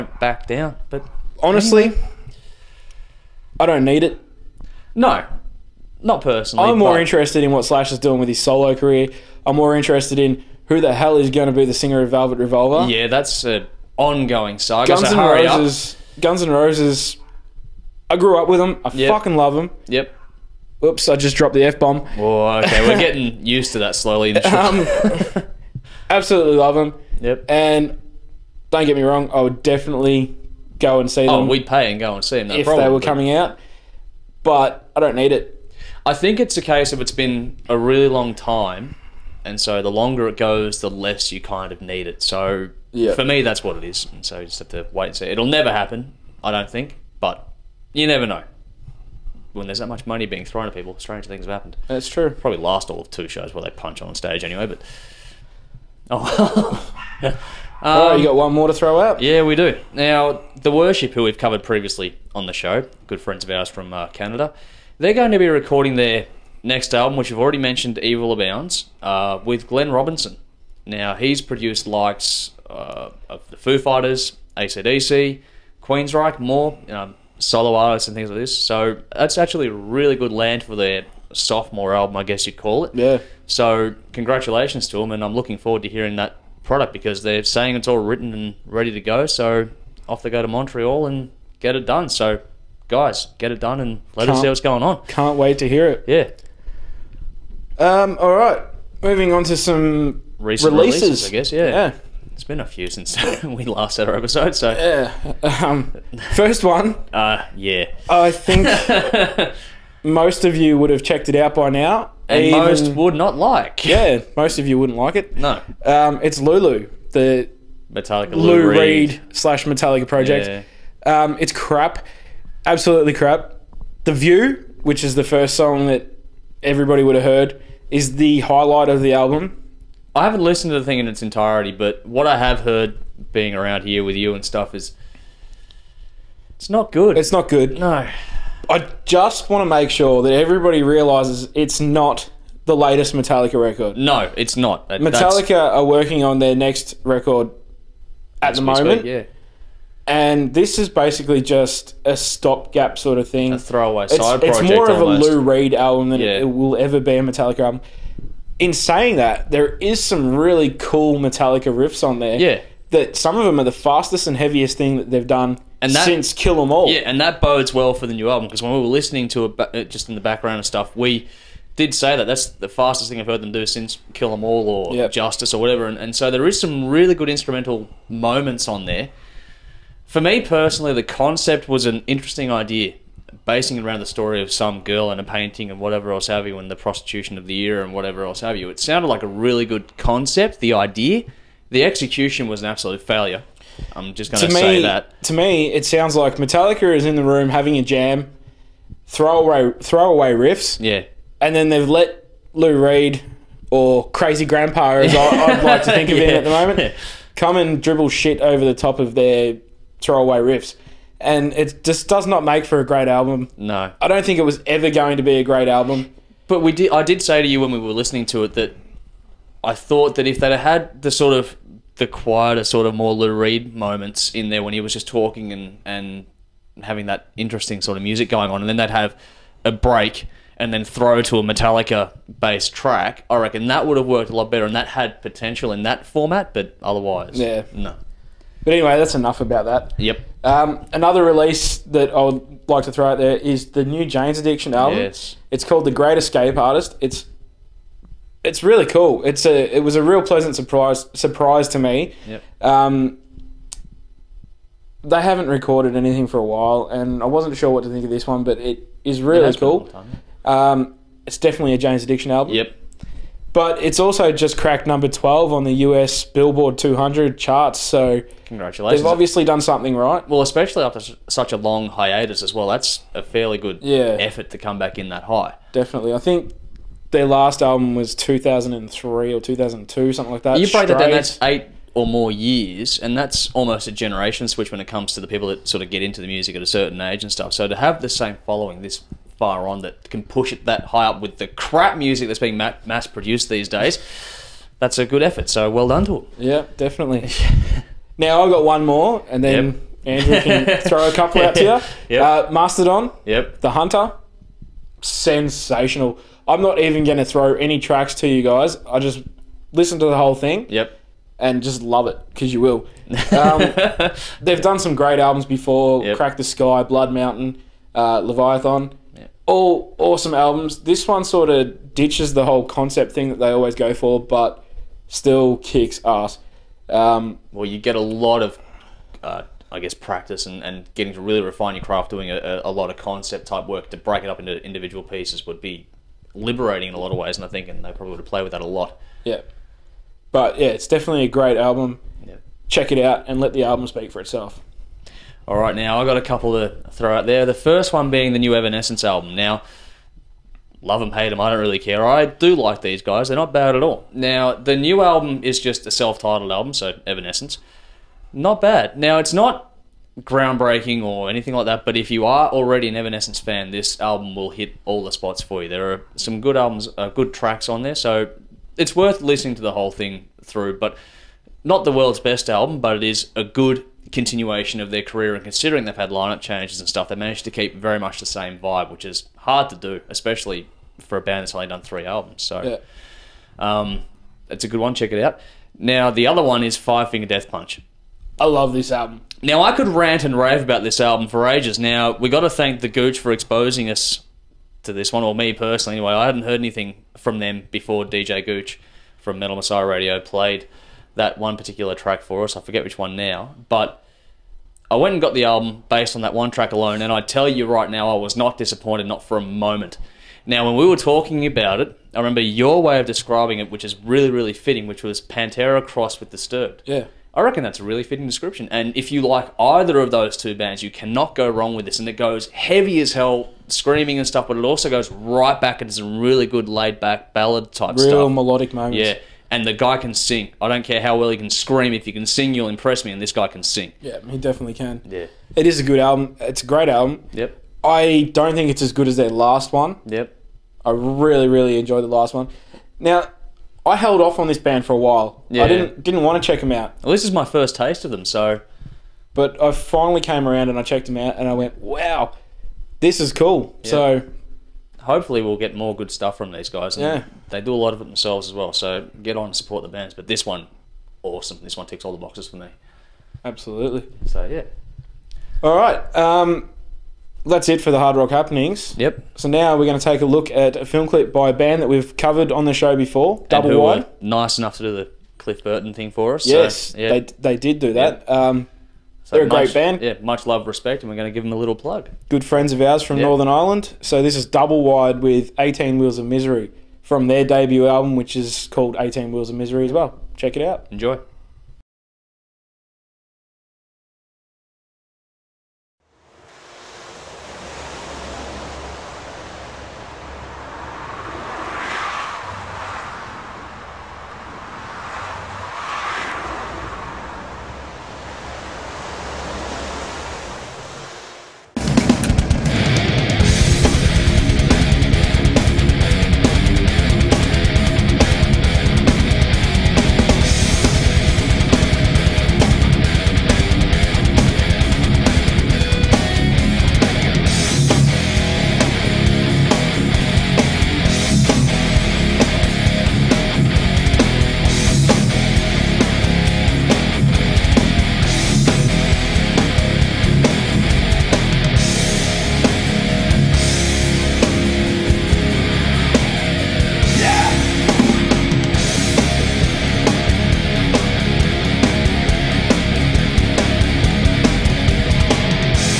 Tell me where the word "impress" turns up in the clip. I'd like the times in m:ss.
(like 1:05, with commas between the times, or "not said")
7:12.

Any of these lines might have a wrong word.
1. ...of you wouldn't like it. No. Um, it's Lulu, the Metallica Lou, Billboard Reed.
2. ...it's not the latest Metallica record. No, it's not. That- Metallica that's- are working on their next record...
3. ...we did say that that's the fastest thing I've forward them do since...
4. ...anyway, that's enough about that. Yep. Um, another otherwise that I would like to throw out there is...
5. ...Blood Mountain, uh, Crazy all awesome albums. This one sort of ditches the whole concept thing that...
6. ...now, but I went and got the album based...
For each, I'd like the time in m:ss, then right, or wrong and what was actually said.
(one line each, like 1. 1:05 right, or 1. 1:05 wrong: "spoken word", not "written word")
1. 1:54 wrong: "Lou", not "Billboard"
2. 2:21 right
3. 2:50 wrong: "heard", not "forward"
4. 3:58 wrong: "release", not "otherwise"
5. 5:16 wrong: "Leviathan", not "Crazy"
6. 6:43 right.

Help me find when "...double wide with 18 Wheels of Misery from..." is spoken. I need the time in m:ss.
8:04.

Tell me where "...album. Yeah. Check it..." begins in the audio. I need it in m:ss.
5:41.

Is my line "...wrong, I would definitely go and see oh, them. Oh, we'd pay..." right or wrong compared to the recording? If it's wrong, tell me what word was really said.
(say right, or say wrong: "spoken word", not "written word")
right.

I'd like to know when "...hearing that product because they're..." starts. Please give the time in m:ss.
1:25.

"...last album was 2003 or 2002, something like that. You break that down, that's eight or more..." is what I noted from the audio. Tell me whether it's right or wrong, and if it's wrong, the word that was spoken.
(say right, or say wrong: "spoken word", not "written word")
right.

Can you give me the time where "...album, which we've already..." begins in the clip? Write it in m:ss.
1:06.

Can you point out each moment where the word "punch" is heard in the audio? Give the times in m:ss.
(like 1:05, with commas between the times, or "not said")
0:53, 6:27.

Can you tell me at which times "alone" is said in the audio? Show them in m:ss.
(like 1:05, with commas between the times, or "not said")
6:46.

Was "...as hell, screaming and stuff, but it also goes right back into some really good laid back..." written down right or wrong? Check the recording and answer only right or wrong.
right.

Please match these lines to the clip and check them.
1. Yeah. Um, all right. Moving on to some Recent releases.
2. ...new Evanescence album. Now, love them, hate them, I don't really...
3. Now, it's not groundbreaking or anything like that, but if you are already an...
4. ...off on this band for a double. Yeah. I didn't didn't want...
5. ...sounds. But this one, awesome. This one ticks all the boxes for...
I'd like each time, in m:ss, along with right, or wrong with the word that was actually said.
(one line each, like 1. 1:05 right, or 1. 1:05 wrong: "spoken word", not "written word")
1. 1:36 right
2. 5:48 right
3. 5:58 right
4. 7:24 wrong: "while", not "double"
5. 7:39 wrong: "bands", not "sounds".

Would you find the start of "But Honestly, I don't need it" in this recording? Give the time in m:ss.
0:00.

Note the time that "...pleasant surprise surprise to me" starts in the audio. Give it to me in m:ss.
4:10.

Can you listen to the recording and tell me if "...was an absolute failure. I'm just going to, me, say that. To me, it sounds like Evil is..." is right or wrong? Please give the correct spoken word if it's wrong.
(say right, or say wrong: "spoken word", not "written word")
wrong: "Metallica", not "Evil".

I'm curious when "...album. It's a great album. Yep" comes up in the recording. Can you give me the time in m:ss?
7:15.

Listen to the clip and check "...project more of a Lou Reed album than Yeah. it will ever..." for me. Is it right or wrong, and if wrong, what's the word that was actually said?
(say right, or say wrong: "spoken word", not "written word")
right.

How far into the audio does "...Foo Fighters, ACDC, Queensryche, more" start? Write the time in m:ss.
1:13.